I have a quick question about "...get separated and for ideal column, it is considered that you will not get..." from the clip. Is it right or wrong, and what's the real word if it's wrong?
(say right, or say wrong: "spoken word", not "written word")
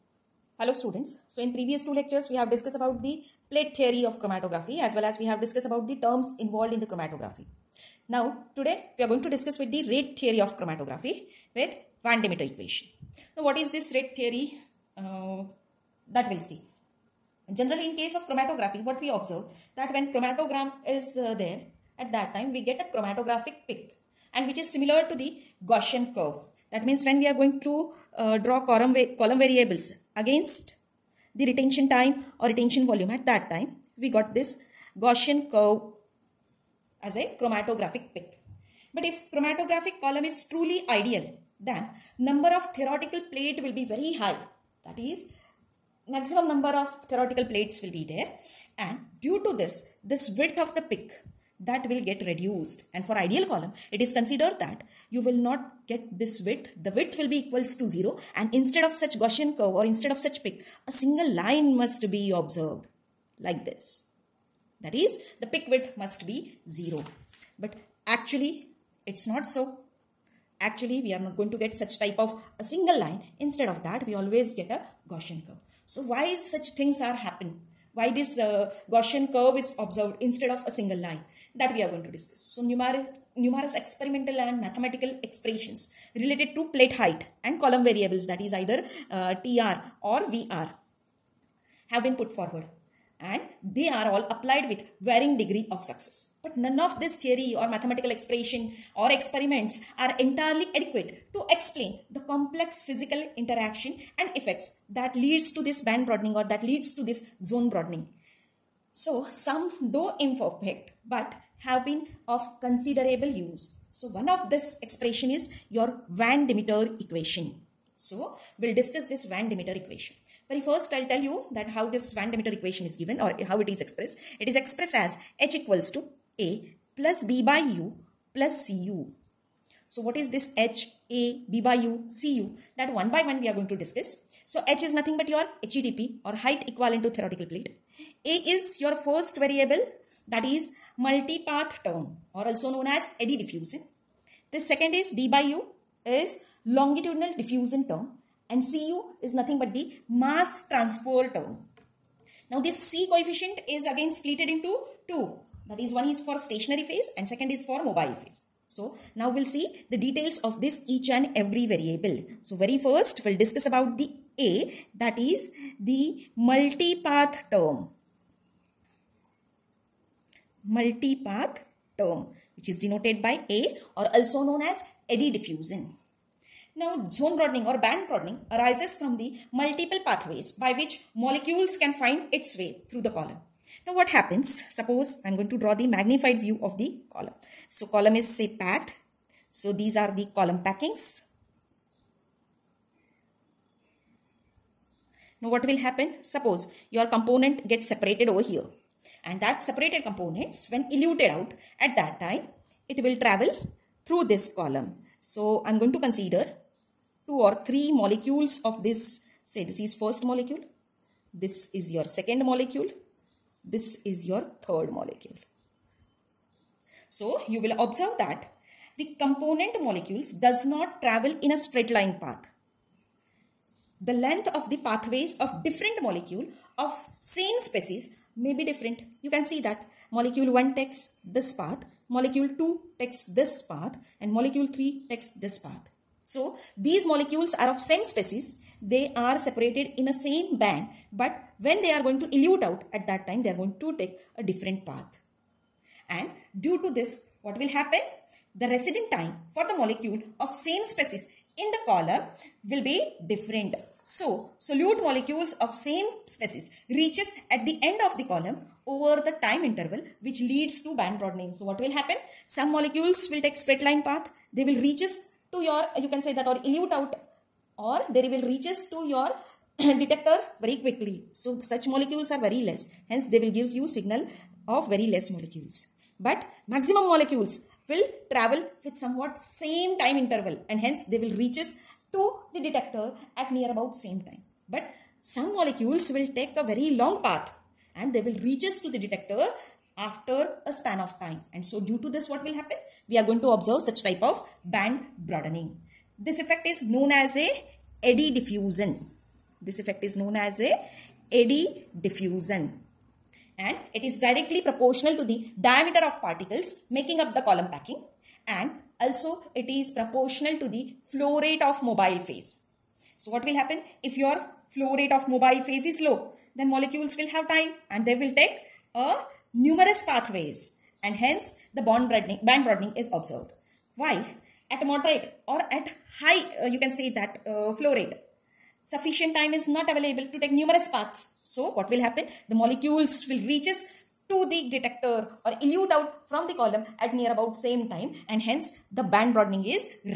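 wrong: "reduced", not "separated".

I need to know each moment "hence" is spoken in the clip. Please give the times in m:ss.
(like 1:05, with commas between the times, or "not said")
4:33, 4:40, 5:21, 5:38.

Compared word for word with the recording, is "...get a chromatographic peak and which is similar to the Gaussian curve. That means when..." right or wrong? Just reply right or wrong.
right.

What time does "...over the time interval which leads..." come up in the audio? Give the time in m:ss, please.
4:18.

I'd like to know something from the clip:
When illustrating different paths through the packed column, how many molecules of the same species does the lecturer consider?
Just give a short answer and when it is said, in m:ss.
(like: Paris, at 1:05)
3, at 3:27.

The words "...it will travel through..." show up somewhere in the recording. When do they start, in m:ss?
3:22.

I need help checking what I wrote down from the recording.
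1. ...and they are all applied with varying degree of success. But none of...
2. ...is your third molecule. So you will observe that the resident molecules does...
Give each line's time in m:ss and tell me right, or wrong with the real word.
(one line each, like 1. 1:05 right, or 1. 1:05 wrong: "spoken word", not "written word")
1. 1:33 right
2. 3:34 wrong: "component", not "resident".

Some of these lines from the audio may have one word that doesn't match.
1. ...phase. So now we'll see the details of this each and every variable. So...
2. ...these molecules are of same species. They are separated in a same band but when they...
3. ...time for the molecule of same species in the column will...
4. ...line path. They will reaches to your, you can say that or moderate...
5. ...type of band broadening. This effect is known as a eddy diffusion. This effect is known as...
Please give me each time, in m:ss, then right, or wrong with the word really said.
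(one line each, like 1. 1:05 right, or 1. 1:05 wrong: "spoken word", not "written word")
1. 2:38 right
2. 3:56 right
3. 4:09 right
4. 4:23 wrong: "elute", not "moderate"
5. 4:54 right.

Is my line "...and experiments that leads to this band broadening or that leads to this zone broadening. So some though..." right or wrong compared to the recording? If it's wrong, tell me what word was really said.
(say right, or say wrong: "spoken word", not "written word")
wrong: "effects", not "experiments".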